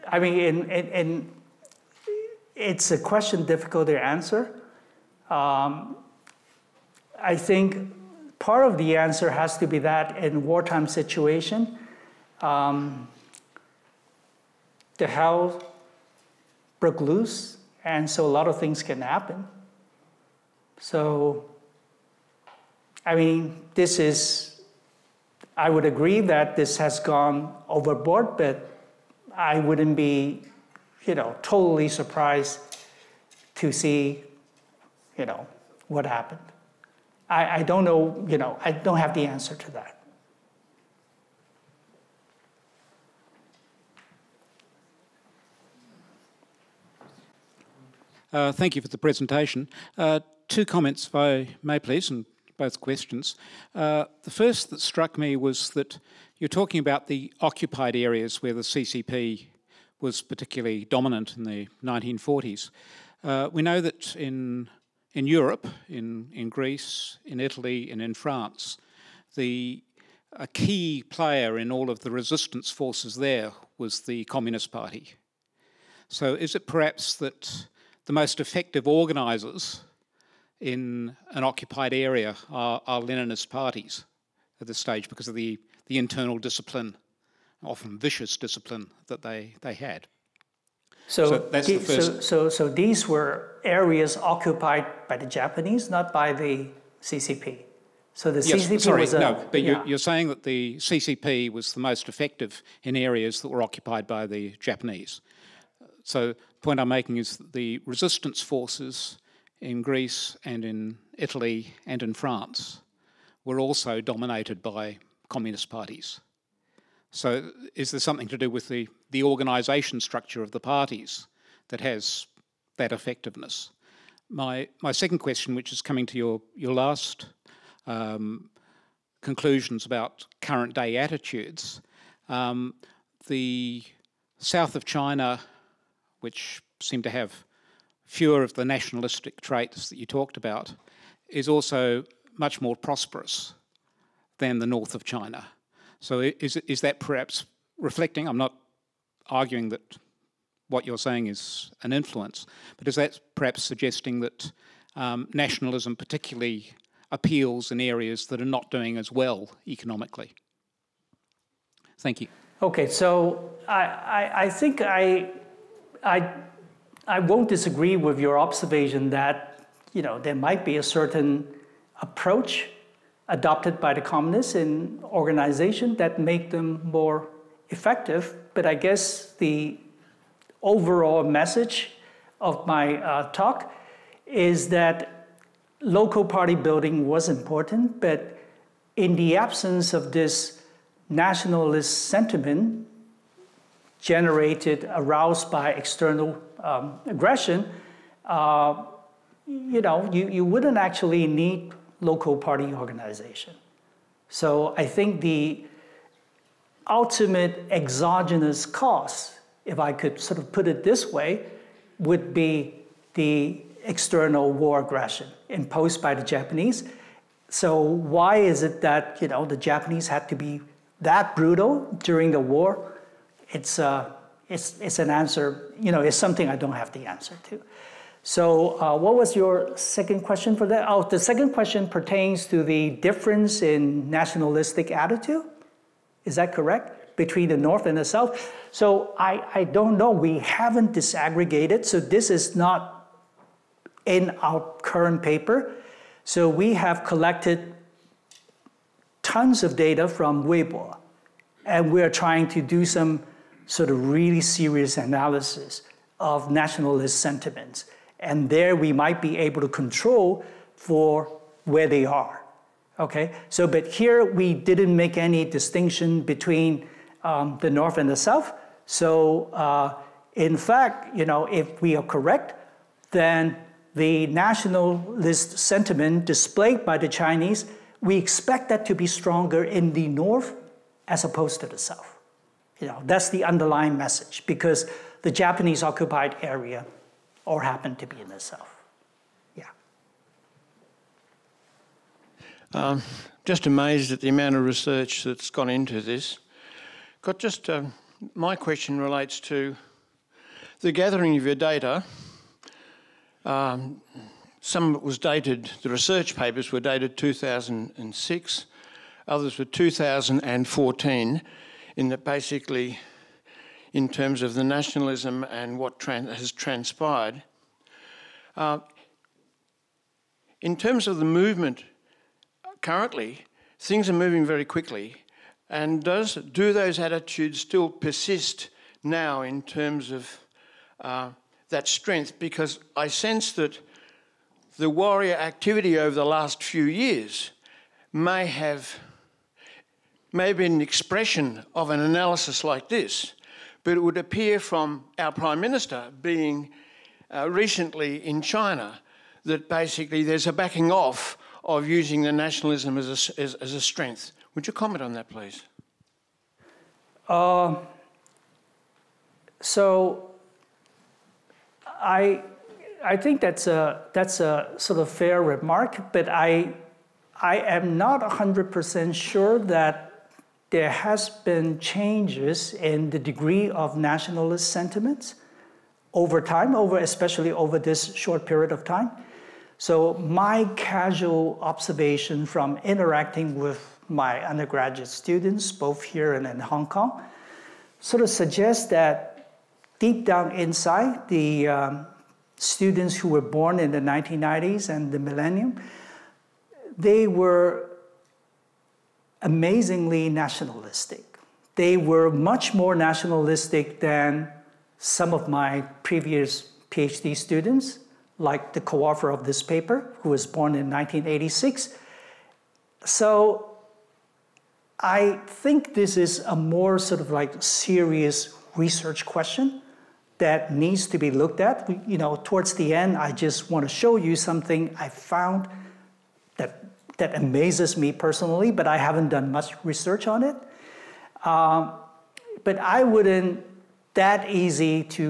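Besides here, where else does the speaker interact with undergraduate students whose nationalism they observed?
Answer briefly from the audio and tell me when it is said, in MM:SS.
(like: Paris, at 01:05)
Hong Kong, at 06:26.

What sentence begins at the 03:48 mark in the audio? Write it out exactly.
So uh, what was your second question for that?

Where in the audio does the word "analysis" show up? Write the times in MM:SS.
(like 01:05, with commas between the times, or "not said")
04:14, 05:41.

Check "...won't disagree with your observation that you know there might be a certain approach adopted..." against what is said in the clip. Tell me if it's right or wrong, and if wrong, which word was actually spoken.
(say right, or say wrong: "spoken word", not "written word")
right.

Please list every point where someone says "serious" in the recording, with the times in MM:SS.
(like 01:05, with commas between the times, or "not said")
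04:14, 06:57.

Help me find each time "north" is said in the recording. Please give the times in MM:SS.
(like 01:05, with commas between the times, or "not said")
02:24, 03:57, 04:27, 04:40.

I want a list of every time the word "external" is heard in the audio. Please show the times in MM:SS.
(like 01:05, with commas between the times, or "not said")
03:15, 03:33.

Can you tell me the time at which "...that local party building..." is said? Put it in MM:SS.
03:04.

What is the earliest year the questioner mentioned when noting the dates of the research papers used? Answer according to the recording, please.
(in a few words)
2006.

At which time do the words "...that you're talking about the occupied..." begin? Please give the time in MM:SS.
00:55.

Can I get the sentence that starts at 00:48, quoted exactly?
Uh, thank you for the presentation.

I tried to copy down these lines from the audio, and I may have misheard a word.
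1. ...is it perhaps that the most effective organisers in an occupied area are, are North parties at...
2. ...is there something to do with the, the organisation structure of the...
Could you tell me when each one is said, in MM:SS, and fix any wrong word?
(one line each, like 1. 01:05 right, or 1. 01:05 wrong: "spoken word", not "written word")
1. 01:16 wrong: "Leninist", not "North"
2. 01:57 right.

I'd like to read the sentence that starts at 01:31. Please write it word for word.
So, so, the so, so, so these were areas occupied by the Japanese, not by the CCP.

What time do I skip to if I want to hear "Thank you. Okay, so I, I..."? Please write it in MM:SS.
02:41.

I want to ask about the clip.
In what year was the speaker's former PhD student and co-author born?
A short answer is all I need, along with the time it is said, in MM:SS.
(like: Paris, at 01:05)
1986, at 06:50.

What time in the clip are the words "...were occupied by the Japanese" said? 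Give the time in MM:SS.
01:43.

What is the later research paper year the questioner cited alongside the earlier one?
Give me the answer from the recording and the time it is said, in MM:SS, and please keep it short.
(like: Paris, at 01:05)
2014, at 05:09.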